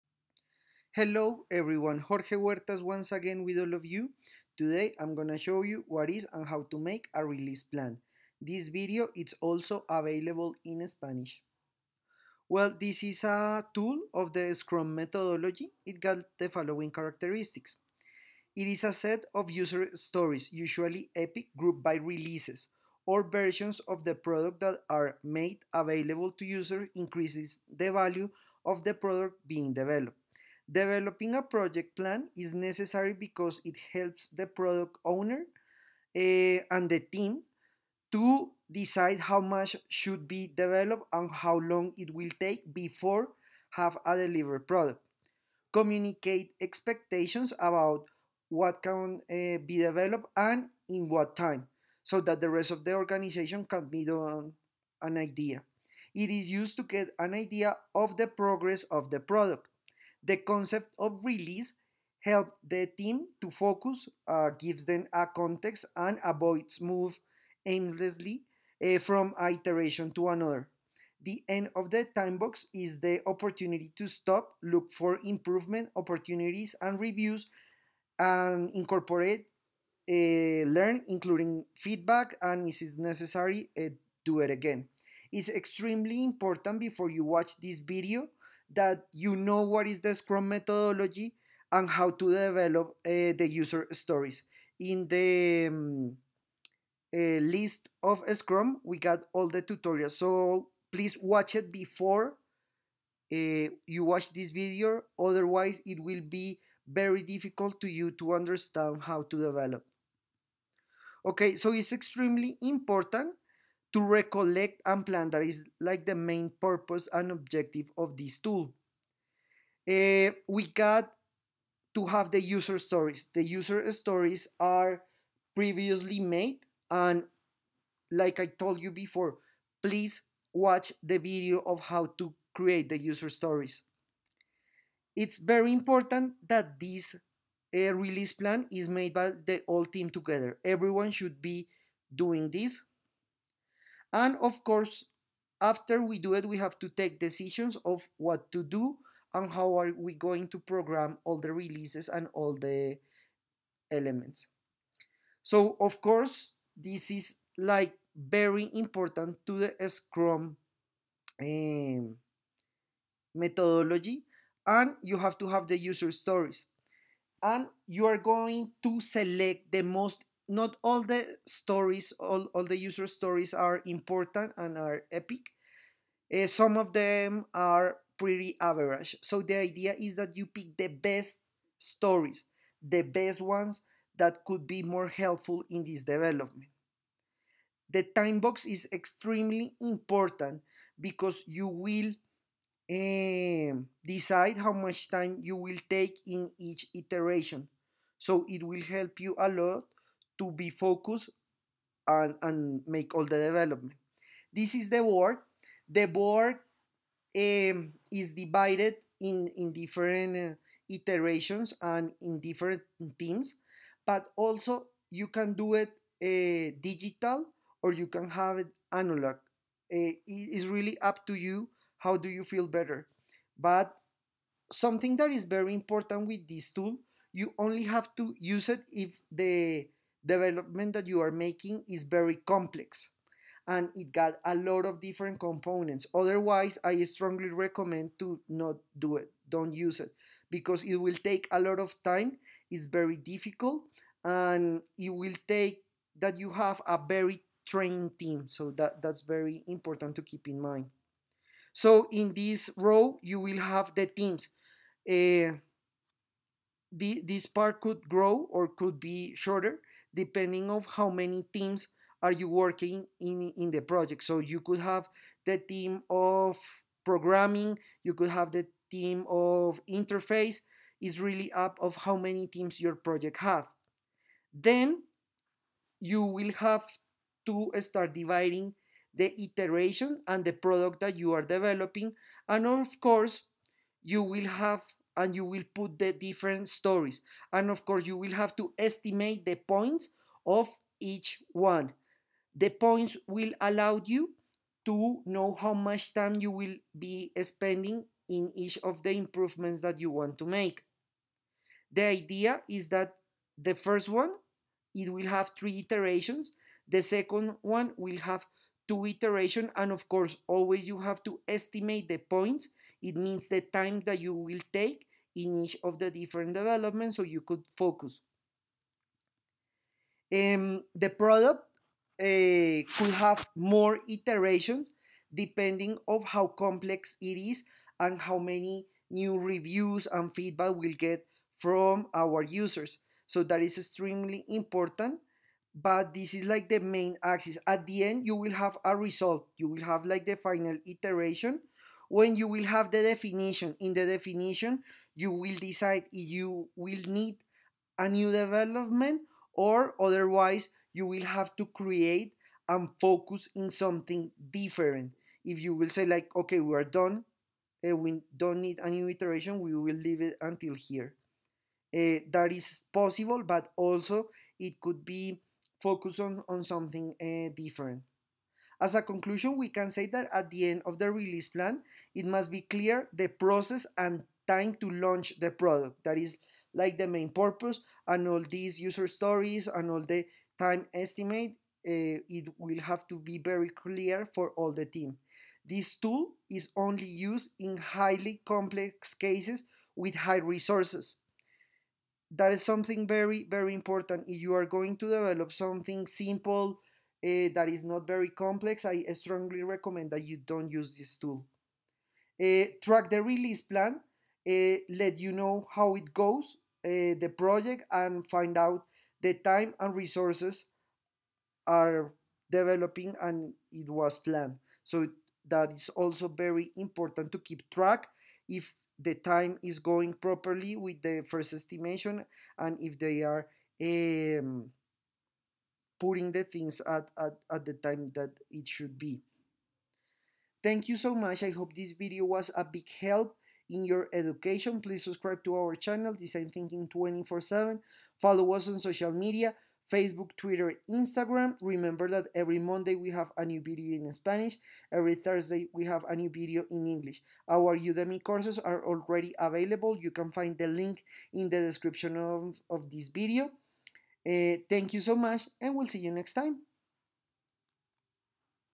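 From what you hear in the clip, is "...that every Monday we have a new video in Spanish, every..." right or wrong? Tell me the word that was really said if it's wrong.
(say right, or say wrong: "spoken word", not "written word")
right.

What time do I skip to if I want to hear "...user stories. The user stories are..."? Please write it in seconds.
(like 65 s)
122 s.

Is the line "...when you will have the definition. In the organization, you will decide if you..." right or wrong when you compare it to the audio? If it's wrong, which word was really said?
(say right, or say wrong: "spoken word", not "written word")
wrong: "definition", not "organization".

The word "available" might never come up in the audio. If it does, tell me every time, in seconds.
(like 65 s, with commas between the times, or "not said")
9 s, 25 s, 449 s.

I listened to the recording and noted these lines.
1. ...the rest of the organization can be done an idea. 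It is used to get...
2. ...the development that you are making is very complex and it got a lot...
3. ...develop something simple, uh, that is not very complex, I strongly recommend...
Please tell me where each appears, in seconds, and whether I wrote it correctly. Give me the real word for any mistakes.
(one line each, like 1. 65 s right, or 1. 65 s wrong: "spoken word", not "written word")
1. 52 s right
2. 229 s right
3. 395 s right.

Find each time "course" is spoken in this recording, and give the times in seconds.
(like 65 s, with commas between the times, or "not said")
144 s, 156 s, 283 s, 287 s, 310 s, 448 s.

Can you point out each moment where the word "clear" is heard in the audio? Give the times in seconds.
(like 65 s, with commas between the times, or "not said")
372 s, 383 s.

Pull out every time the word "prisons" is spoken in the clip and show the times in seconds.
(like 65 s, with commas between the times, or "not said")
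not said.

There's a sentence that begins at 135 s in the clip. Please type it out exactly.
It's very important that this uh, release plan is made by the whole team together.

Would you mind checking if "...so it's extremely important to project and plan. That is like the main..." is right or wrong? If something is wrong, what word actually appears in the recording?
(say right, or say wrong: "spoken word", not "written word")
wrong: "recollect", not "project".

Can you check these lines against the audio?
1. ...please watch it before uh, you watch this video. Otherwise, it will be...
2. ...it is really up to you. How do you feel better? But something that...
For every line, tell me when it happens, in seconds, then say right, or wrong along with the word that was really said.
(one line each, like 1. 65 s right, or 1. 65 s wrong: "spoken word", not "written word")
1. 100 s right
2. 219 s right.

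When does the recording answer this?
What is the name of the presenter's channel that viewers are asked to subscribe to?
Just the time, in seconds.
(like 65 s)
436 s.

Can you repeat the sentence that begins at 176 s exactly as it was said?
Uh, some of them are pretty average.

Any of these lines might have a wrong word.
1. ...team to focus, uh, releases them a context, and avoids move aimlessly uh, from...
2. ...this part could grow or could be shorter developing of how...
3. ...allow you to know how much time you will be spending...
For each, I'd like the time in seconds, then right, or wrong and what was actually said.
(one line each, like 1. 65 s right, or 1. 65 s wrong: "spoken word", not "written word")
1. 62 s wrong: "gives", not "releases"
2. 257 s wrong: "depending", not "developing"
3. 293 s right.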